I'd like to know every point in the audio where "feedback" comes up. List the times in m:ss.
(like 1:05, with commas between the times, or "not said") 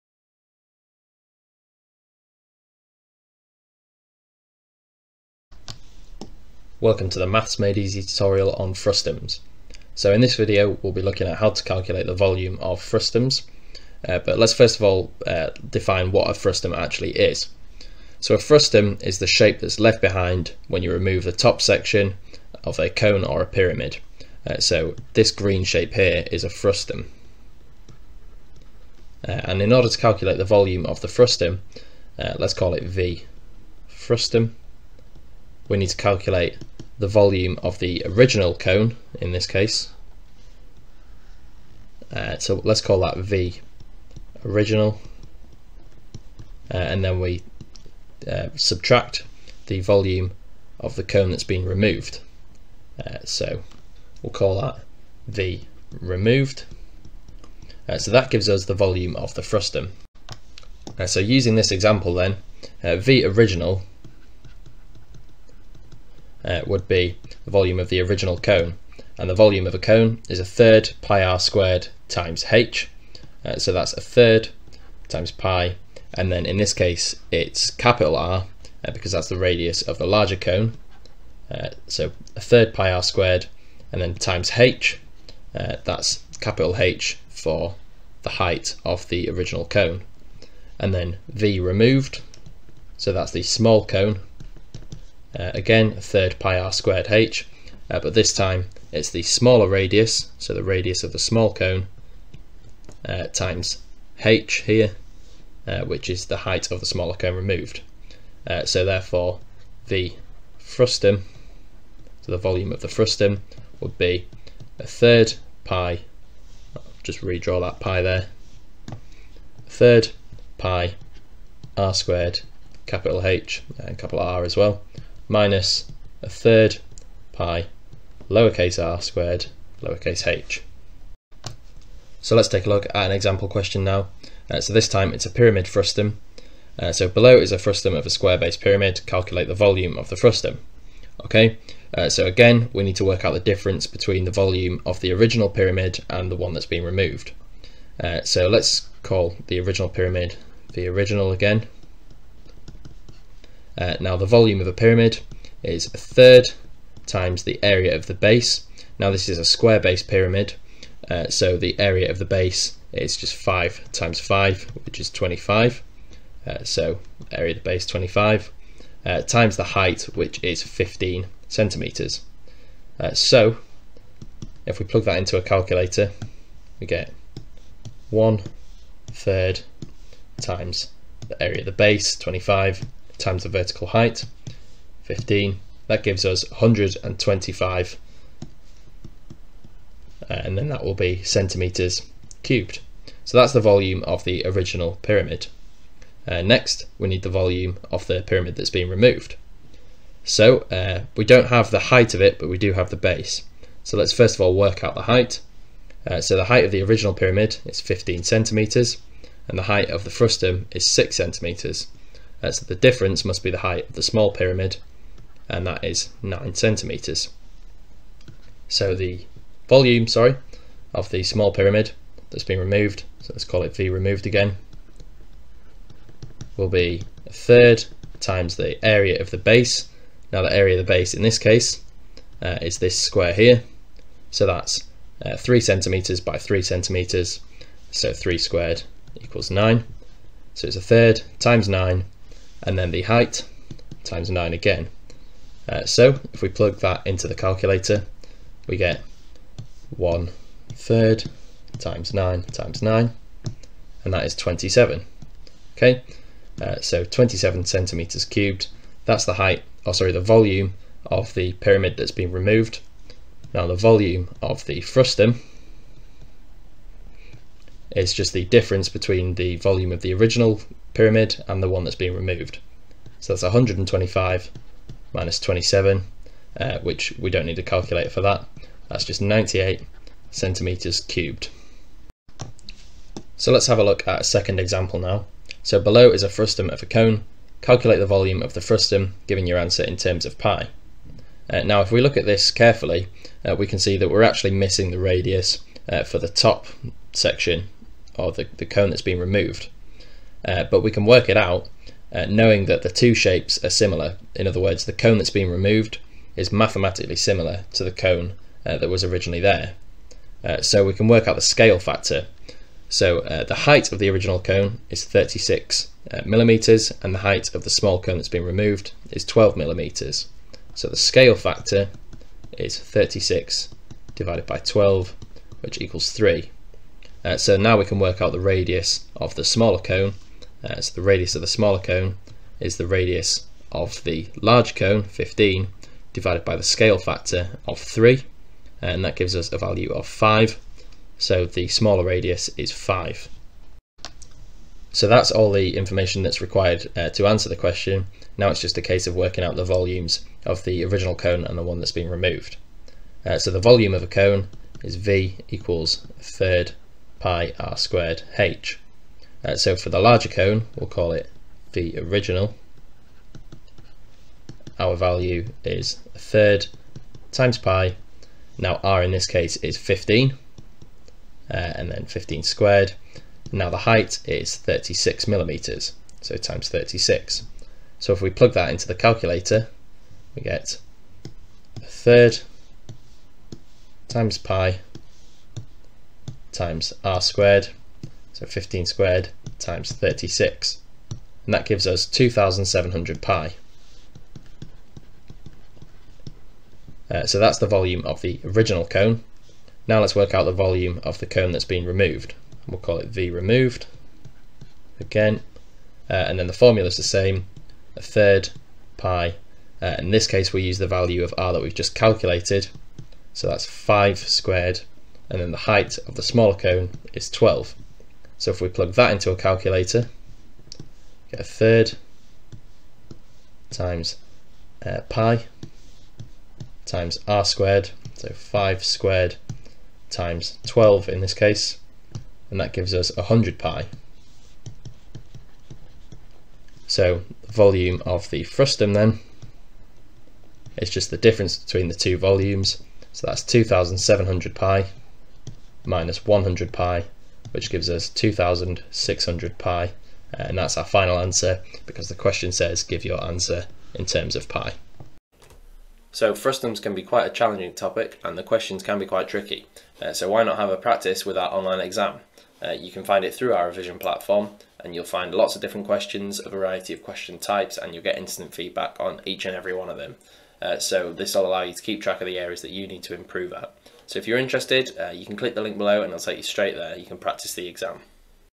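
7:48.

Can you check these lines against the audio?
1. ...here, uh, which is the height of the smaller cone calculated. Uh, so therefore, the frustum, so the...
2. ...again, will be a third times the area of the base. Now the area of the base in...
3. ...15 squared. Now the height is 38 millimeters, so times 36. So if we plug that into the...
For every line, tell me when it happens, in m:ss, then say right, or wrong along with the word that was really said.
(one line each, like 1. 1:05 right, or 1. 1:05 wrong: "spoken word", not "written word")
1. 1:44 wrong: "removed", not "calculated"
2. 3:44 right
3. 6:12 wrong: "36", not "38".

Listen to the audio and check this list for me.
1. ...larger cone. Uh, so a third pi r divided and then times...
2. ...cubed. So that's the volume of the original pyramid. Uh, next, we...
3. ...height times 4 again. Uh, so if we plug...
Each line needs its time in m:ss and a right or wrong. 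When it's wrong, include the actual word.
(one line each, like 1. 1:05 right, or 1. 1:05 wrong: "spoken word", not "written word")
1. 1:20 wrong: "squared", not "divided"
2. 3:12 right
3. 4:03 wrong: "9", not "4".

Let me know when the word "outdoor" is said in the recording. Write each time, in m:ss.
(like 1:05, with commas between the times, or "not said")
not said.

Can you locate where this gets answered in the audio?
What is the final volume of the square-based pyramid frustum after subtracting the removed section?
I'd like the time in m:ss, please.
4:39.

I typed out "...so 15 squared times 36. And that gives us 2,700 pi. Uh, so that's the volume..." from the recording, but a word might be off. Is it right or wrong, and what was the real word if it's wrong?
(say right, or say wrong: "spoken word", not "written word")
right.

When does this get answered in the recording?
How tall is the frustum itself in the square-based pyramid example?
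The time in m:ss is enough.
3:30.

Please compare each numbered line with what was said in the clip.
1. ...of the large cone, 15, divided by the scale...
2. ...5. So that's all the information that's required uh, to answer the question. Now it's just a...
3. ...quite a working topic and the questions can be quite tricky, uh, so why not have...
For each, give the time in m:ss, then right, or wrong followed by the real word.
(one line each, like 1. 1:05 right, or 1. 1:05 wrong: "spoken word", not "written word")
1. 5:33 right
2. 5:42 right
3. 7:37 wrong: "challenging", not "working".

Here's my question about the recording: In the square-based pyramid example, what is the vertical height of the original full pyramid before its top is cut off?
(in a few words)
15 centimetres.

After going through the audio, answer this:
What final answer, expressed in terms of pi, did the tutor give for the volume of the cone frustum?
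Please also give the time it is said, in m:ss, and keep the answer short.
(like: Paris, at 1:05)
2600 pi, at 7:28.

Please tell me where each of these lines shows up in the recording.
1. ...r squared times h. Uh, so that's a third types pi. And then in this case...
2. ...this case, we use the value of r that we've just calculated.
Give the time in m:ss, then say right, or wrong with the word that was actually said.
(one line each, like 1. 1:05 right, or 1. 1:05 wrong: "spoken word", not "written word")
1. 1:11 wrong: "times", not "types"
2. 6:50 right.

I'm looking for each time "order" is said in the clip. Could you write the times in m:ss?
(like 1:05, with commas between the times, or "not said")
0:29.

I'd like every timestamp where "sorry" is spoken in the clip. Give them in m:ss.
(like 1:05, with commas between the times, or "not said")
3:40, 4:19.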